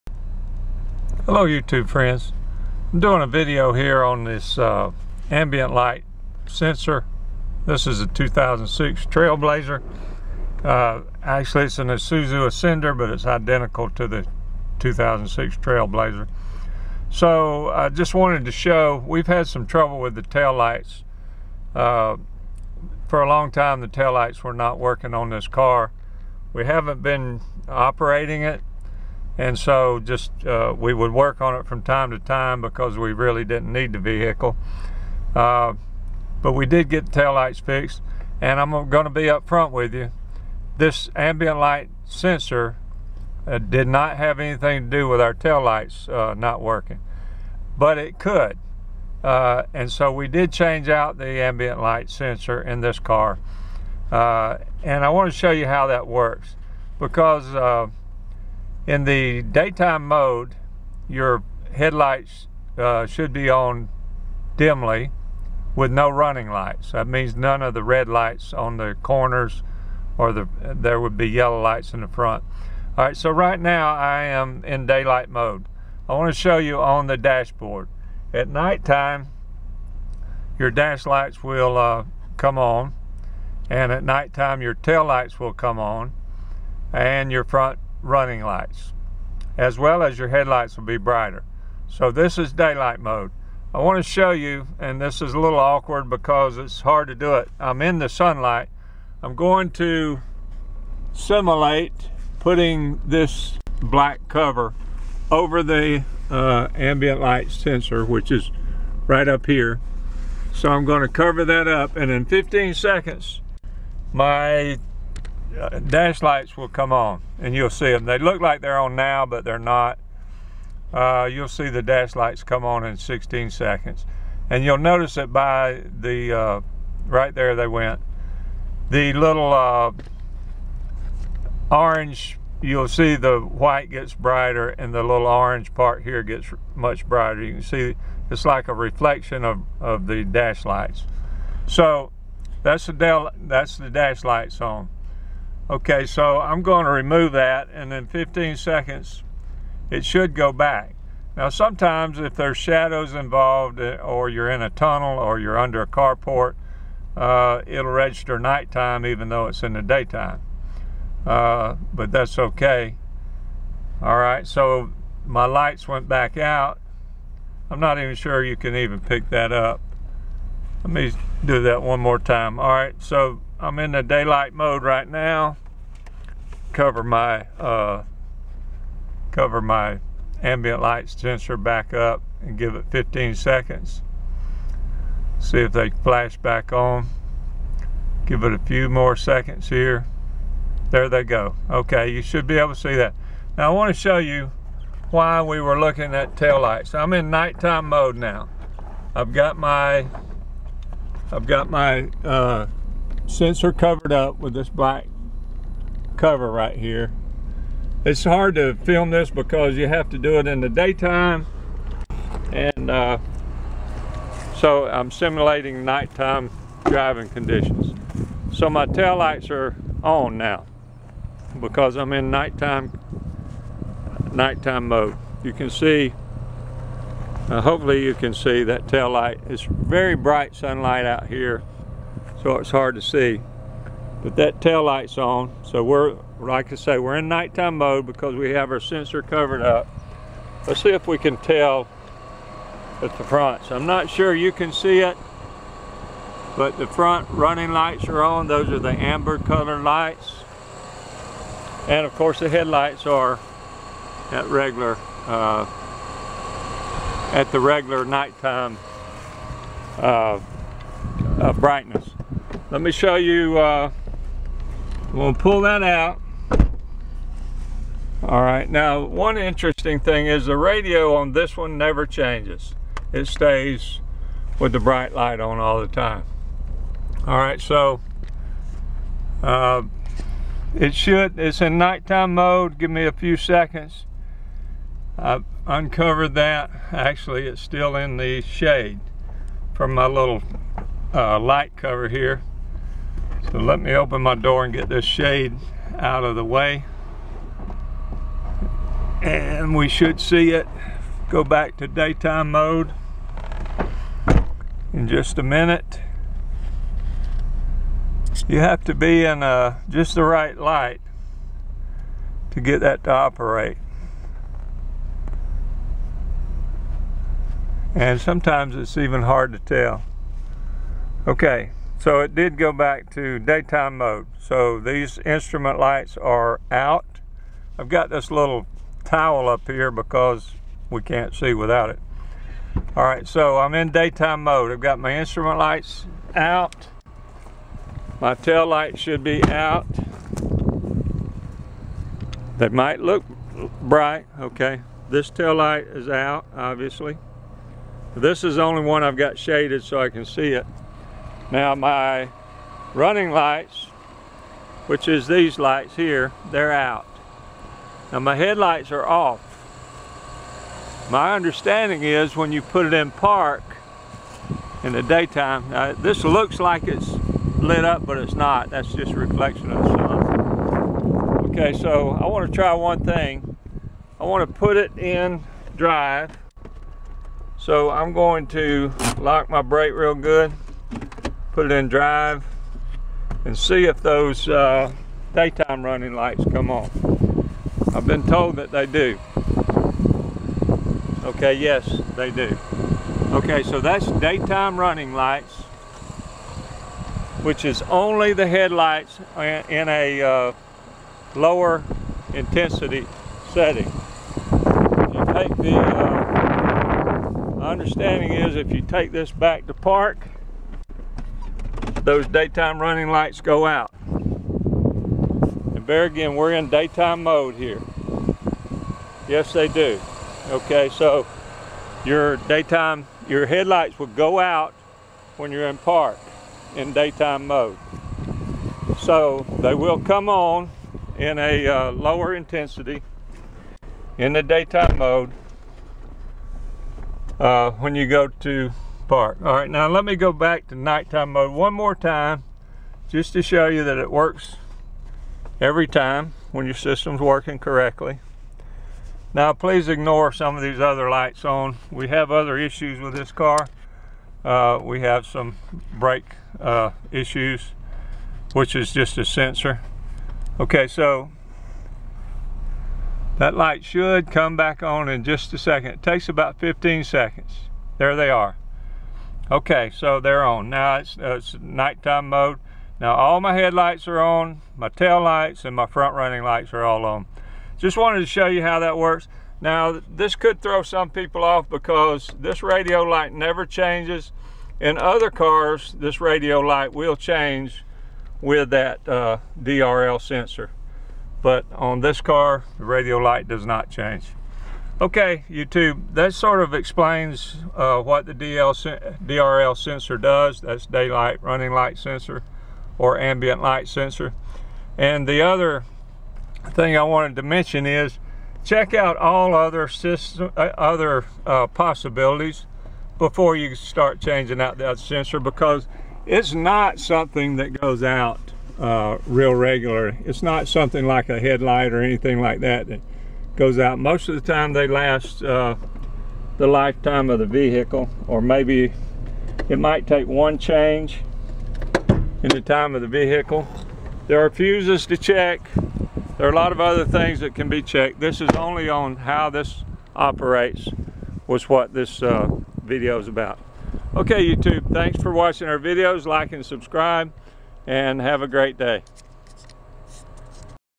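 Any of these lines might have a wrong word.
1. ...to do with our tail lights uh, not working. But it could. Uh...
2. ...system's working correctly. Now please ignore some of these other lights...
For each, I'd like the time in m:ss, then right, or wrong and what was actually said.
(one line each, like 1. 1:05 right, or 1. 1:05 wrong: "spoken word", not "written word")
1. 0:44 right
2. 7:26 right.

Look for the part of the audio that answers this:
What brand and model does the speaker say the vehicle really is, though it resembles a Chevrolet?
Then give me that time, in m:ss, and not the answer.
0:11.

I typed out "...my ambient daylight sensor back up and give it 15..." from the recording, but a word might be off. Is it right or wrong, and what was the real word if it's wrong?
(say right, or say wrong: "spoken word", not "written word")
wrong: "light", not "daylight".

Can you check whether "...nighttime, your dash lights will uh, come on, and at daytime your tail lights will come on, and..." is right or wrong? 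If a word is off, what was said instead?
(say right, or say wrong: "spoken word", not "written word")
wrong: "nighttime", not "daytime".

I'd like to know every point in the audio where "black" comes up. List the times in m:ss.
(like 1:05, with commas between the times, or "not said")
1:43, 3:24.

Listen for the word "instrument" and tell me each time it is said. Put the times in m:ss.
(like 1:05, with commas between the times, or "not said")
5:25, 5:35.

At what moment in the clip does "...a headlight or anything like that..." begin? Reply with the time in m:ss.
8:41.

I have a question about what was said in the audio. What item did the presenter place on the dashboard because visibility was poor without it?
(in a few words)
Towel.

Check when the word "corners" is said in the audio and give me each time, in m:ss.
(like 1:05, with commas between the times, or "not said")
1:09.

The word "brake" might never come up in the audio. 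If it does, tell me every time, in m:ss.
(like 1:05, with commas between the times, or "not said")
6:19, 7:35.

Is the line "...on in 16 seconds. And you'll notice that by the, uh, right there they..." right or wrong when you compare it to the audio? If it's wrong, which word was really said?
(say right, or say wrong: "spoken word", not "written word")
right.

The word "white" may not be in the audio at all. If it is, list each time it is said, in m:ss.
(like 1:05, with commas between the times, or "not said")
2:13.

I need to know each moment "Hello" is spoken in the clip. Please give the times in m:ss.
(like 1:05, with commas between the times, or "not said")
0:01.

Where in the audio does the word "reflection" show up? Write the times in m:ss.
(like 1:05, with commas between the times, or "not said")
2:18, 6:09.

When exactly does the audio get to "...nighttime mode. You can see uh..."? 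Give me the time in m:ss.
3:44.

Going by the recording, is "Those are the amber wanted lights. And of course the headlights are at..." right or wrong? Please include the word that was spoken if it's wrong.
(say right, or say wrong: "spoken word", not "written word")
wrong: "colored", not "wanted".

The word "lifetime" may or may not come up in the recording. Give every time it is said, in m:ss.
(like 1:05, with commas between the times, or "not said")
8:46.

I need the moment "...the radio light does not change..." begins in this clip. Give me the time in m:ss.
8:12.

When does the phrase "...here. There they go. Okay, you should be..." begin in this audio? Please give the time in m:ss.
3:09.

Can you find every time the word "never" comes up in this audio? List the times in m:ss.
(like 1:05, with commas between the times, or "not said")
4:31, 8:03.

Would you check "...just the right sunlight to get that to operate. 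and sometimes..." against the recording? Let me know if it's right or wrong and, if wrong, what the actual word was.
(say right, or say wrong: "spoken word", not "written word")
wrong: "light", not "sunlight".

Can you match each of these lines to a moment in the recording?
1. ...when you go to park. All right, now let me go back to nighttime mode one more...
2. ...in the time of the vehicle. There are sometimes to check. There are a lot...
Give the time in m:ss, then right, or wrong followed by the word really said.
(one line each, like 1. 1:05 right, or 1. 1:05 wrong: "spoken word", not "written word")
1. 7:17 right
2. 8:52 wrong: "fuses", not "sometimes".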